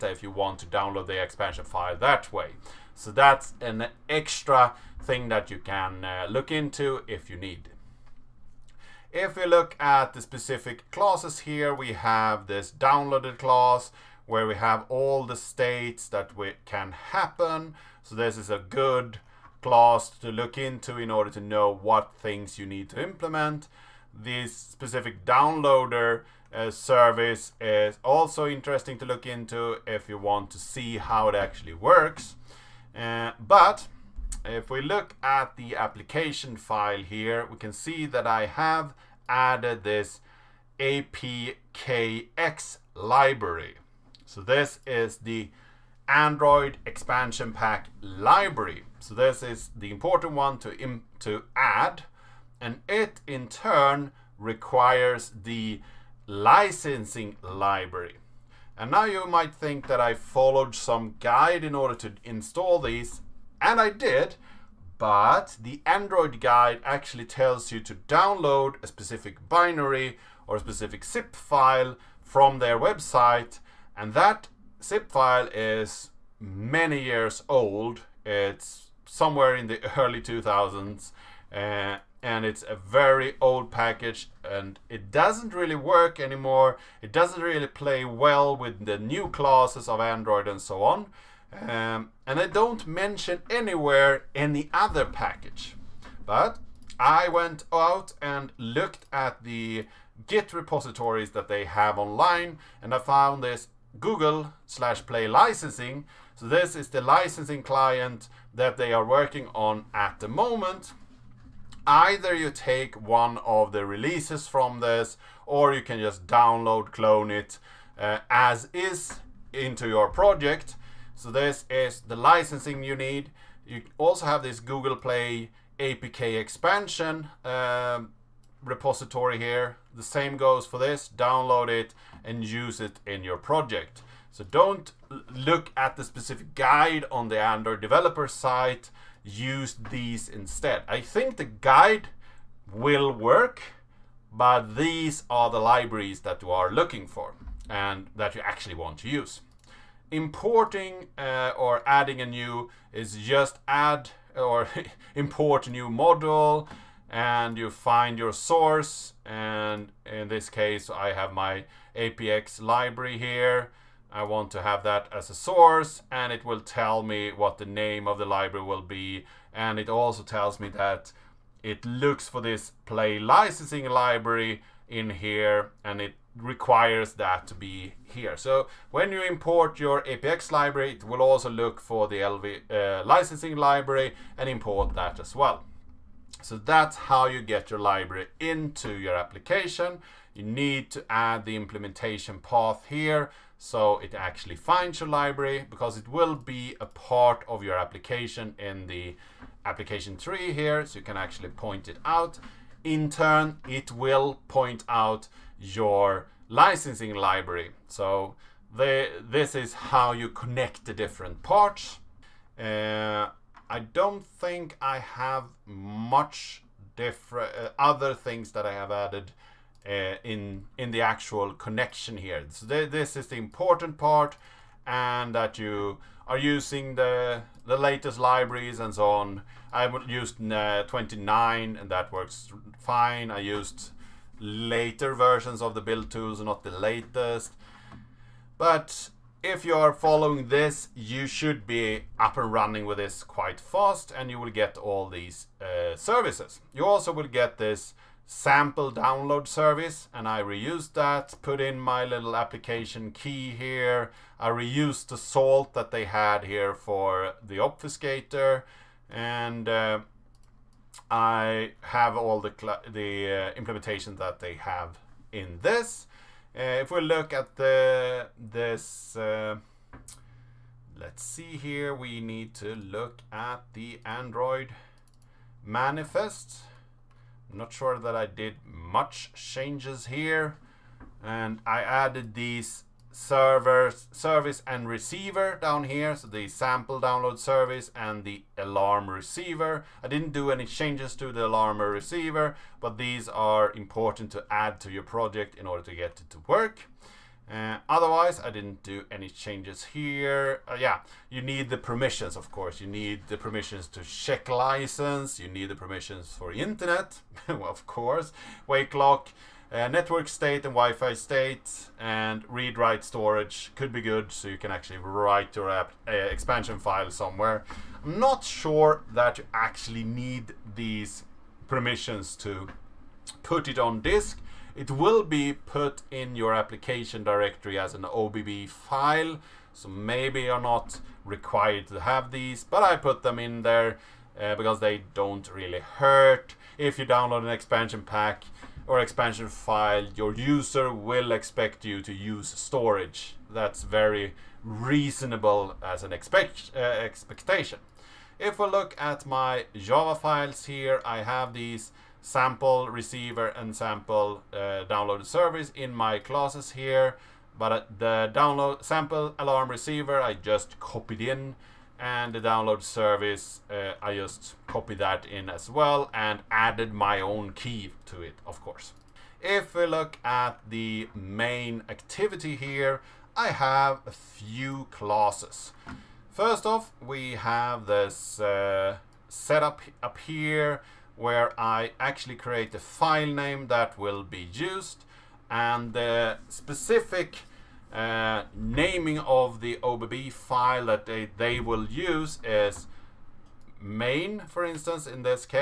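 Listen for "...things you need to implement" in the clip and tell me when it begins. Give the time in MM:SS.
00:22.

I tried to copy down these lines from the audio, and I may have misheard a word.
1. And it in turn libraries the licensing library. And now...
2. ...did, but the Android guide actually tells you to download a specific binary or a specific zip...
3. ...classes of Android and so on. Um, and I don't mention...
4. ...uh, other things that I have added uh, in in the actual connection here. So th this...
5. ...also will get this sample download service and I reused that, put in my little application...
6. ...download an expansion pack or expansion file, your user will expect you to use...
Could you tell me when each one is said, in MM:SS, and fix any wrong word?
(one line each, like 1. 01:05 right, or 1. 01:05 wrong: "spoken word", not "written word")
1. 00:52 wrong: "requires", not "libraries"
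2. 01:03 right
3. 01:29 right
4. 03:37 right
5. 04:06 right
6. 05:37 right.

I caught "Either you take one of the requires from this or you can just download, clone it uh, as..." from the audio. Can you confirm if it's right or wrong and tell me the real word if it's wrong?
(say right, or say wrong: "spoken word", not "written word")
wrong: "releases", not "requires".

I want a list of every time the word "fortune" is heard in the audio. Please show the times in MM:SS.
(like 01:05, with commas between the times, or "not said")
not said.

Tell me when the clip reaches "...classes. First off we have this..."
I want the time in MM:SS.
06:14.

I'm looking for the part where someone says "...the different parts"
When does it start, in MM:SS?
03:30.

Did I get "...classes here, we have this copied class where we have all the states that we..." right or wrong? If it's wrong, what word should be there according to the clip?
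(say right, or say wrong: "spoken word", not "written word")
wrong: "downloaded", not "copied".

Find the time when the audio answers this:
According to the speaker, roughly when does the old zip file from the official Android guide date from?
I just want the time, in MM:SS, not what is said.
01:19.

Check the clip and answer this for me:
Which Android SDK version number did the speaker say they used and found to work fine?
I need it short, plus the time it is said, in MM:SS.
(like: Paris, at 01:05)
29, at 03:50.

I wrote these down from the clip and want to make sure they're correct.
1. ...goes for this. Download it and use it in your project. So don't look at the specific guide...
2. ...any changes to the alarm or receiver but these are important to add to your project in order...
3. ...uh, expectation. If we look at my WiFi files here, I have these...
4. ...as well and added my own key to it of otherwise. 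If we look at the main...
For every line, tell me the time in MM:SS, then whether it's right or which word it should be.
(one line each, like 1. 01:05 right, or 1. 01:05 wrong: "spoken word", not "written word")
1. 02:10 right
2. 04:50 right
3. 05:46 wrong: "Java", not "WiFi"
4. 06:05 wrong: "course", not "otherwise".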